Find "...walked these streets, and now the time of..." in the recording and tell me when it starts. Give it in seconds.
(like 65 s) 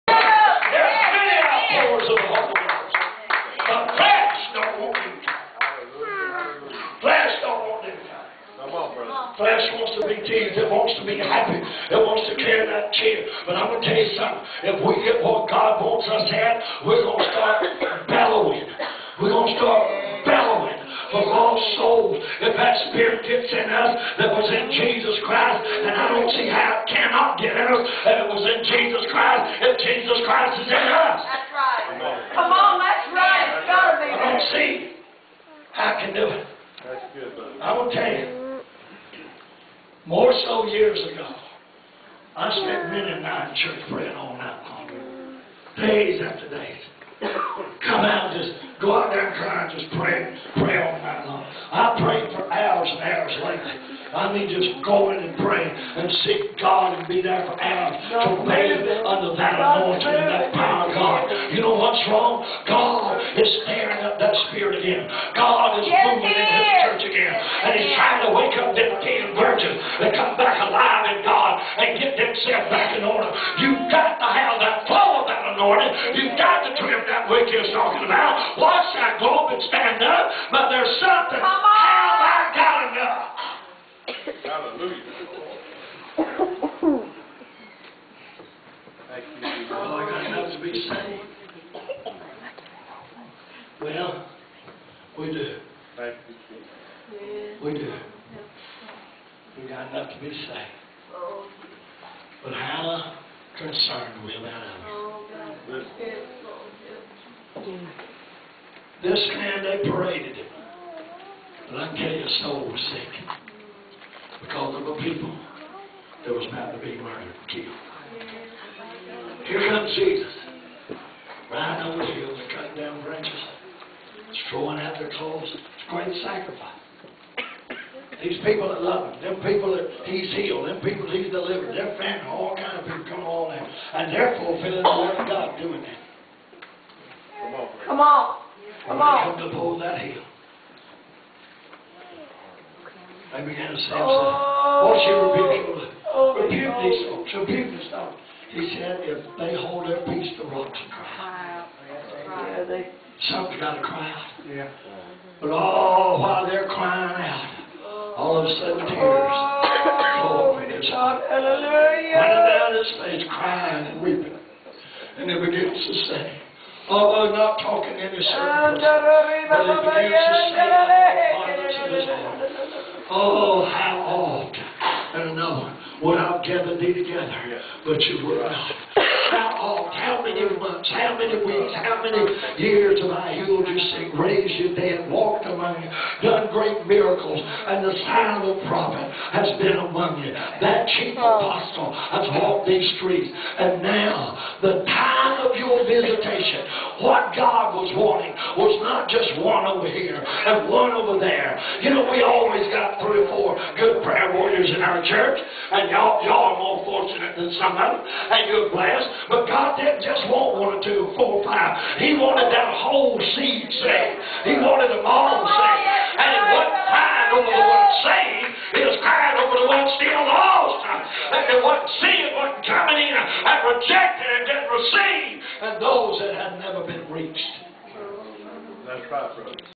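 192 s.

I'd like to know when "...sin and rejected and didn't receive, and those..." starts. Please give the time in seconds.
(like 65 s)
221 s.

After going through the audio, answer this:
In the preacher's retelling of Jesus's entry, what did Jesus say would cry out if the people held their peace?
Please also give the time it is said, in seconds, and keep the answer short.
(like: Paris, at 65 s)
the rocks, at 150 s.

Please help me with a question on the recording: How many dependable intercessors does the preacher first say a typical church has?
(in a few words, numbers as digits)
3.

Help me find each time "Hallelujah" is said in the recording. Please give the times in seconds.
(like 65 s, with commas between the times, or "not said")
84 s, 161 s.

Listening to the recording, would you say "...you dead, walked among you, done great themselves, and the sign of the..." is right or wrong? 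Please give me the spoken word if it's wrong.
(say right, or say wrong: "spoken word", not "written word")
wrong: "miracles", not "themselves".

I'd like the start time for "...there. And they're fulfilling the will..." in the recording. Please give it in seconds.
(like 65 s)
133 s.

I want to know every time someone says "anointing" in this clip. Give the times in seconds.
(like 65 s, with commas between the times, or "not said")
59 s, 75 s.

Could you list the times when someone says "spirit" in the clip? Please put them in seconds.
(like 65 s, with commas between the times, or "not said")
22 s, 64 s.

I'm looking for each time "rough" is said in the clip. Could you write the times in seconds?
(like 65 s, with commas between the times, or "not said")
not said.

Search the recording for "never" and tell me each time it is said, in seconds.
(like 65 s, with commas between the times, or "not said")
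226 s.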